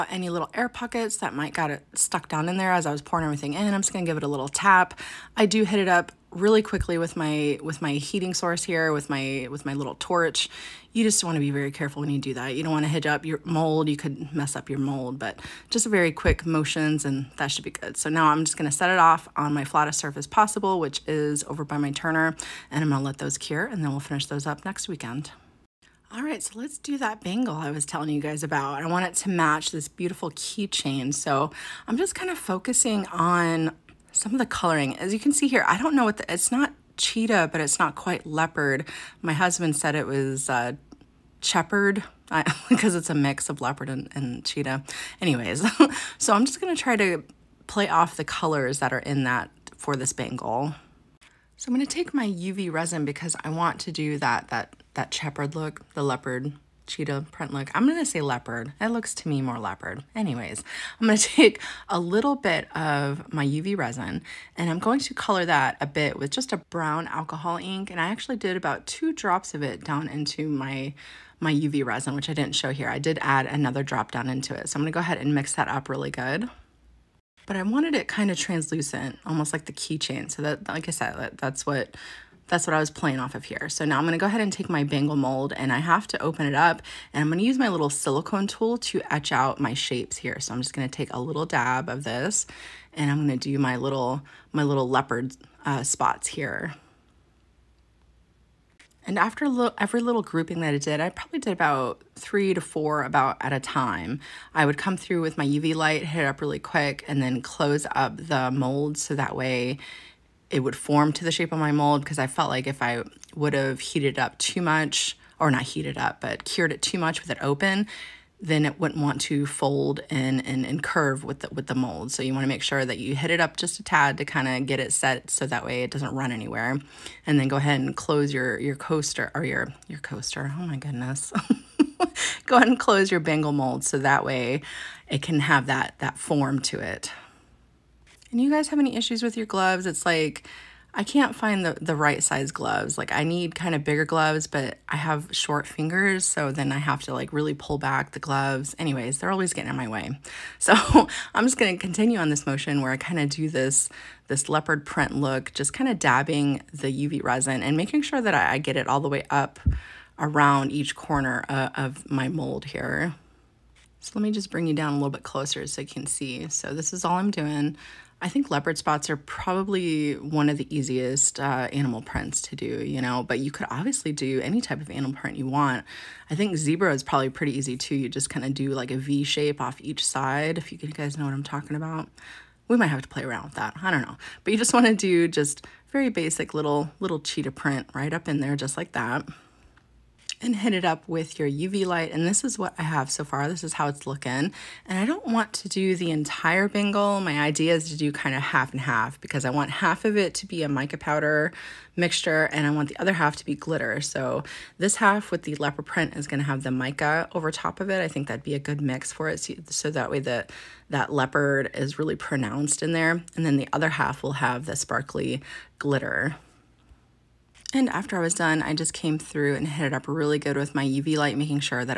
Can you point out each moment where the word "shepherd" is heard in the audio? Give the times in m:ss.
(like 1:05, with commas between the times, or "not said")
0:41, 0:55.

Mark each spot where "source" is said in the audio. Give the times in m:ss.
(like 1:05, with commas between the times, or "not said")
0:08.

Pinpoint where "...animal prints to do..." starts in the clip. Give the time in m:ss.
2:51.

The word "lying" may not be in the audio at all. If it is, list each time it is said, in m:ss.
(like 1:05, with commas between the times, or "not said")
not said.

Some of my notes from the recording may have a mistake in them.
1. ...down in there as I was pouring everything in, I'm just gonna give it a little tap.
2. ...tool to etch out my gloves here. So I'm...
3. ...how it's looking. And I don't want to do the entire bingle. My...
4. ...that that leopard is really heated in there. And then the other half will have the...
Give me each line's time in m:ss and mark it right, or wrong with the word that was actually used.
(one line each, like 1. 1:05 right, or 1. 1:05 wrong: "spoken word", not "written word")
1. 0:02 right
2. 1:28 wrong: "shapes", not "gloves"
3. 3:13 right
4. 3:30 wrong: "pronounced", not "heated".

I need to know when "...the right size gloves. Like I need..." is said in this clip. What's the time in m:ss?
2:21.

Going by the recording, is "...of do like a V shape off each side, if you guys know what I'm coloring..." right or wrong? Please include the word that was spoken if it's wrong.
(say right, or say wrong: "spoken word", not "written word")
wrong: "talking", not "coloring".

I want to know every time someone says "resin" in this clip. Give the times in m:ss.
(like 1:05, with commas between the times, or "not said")
0:52, 1:03, 1:11, 2:37.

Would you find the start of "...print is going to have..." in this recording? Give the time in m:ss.
3:25.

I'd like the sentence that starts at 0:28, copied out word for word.
I want it to match this beautiful keychain.